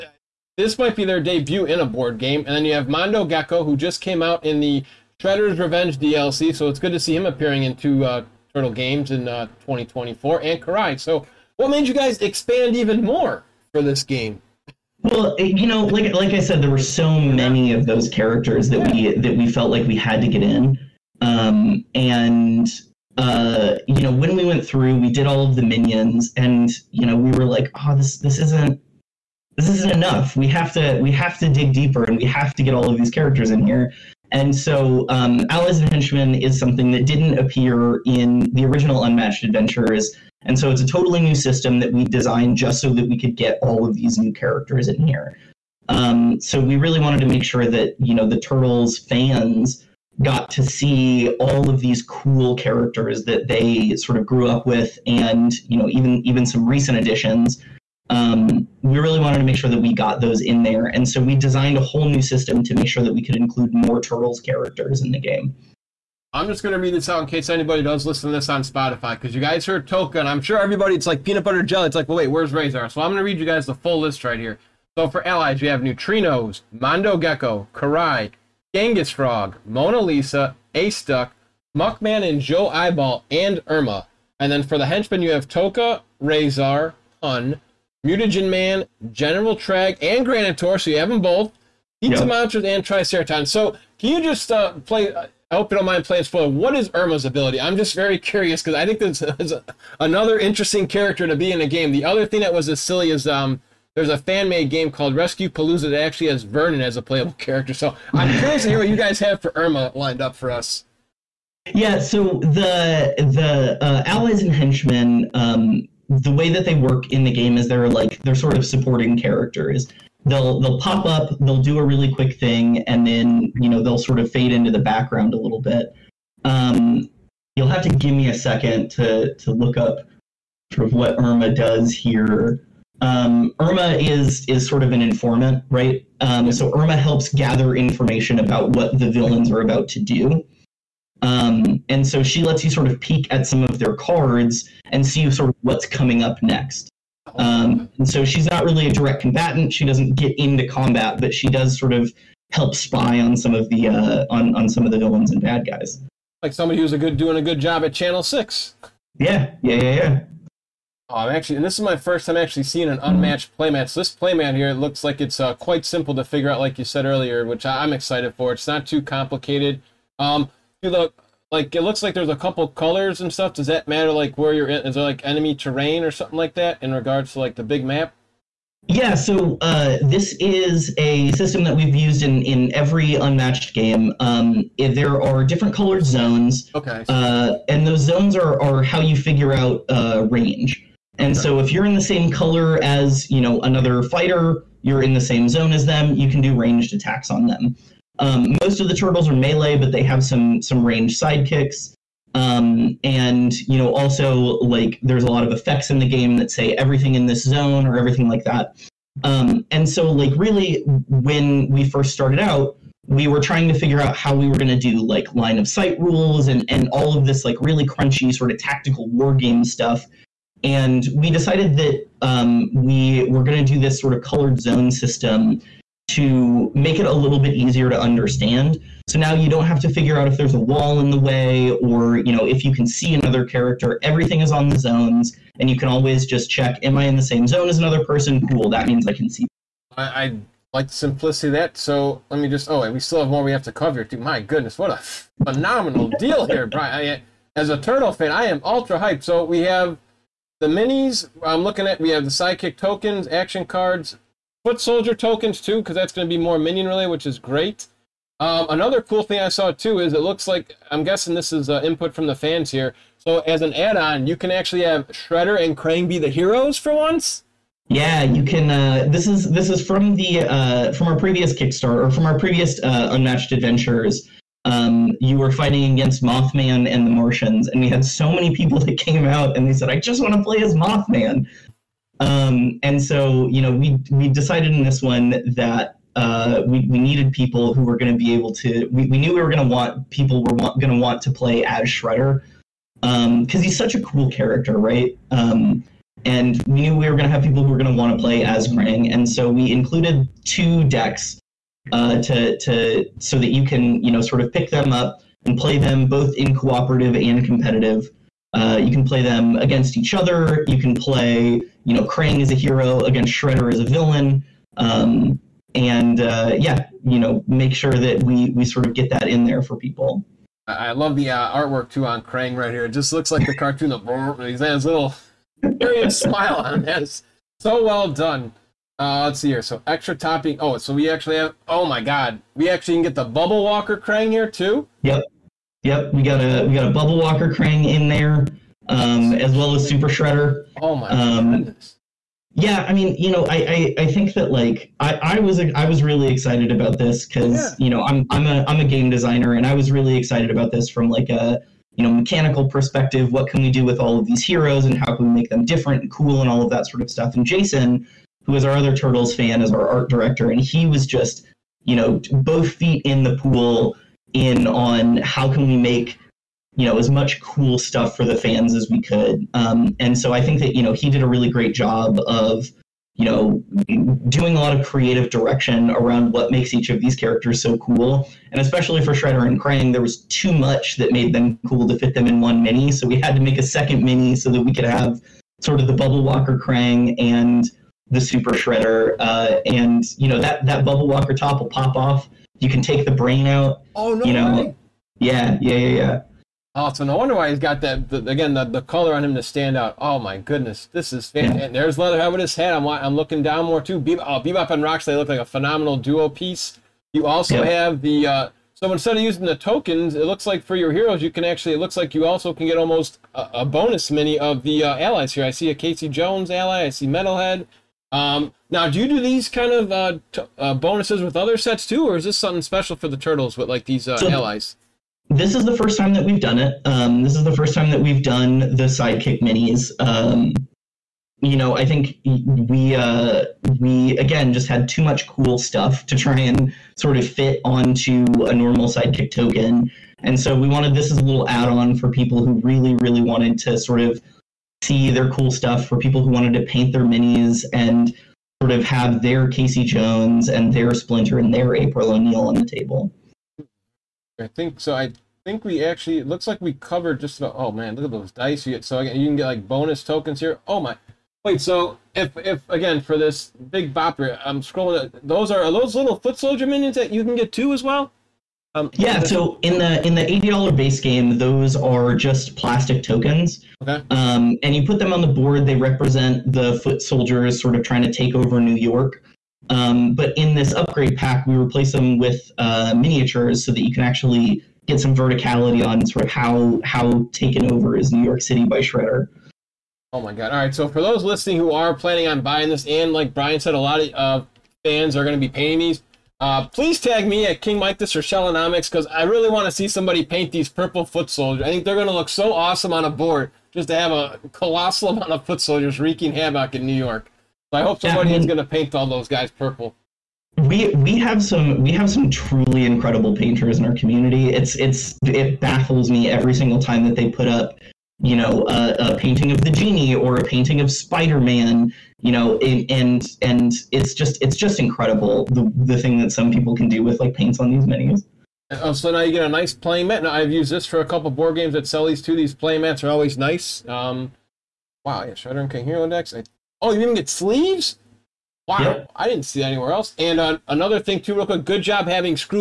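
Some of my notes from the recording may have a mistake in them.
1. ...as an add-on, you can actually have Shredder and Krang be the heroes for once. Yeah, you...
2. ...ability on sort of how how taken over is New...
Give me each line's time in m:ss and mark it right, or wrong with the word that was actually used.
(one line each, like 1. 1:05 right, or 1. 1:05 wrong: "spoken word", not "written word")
1. 4:23 right
2. 8:05 wrong: "verticality", not "ability".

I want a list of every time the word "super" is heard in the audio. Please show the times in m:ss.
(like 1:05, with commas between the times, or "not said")
5:39, 6:28.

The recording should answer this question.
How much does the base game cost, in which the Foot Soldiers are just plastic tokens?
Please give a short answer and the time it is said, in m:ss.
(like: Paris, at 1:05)
$80, at 7:50.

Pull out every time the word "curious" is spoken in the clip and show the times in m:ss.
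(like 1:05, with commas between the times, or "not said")
1:38, 1:48, 5:25.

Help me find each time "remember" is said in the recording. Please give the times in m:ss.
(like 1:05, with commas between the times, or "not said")
not said.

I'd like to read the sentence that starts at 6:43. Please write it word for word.
Be- oh, Bebop and Rocks—they look like a phenomenal duo piece.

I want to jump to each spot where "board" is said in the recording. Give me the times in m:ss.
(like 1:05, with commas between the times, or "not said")
0:01, 7:55, 8:23, 8:51.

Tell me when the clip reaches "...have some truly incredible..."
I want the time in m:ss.
8:31.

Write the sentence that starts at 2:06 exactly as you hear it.
Um, you'll have to give me a second to to look up sort of what Irma does here.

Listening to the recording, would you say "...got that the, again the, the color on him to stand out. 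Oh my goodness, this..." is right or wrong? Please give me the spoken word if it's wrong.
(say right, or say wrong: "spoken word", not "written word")
right.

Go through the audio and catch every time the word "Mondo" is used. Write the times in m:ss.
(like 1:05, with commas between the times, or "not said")
0:02, 1:16.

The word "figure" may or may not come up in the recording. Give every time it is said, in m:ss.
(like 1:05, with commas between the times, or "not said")
2:46, 3:09, 3:33, 3:49.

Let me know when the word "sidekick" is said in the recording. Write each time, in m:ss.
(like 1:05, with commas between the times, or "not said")
3:21, 4:12, 7:08, 7:18.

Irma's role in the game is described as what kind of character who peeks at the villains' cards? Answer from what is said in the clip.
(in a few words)
An informant.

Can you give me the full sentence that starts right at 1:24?
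And then for the henchmen, you have Tokka, Razor, Hun, Mutagen Man, General Traag, and Granitor, so you have them both.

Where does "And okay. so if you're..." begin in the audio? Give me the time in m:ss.
3:11.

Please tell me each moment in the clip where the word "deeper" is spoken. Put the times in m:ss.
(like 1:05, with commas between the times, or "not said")
0:31.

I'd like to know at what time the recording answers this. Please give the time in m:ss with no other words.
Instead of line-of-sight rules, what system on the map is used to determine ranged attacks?
3:44.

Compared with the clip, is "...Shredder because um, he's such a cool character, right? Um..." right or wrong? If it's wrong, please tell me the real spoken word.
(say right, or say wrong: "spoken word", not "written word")
right.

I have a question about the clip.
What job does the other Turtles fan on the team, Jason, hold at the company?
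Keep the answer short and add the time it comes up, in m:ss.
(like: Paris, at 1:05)
Art director, at 5:59.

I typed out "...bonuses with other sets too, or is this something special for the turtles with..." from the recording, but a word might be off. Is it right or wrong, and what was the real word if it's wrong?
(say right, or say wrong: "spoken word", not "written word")
right.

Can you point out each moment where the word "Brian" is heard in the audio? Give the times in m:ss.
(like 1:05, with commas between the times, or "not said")
4:06, 8:13.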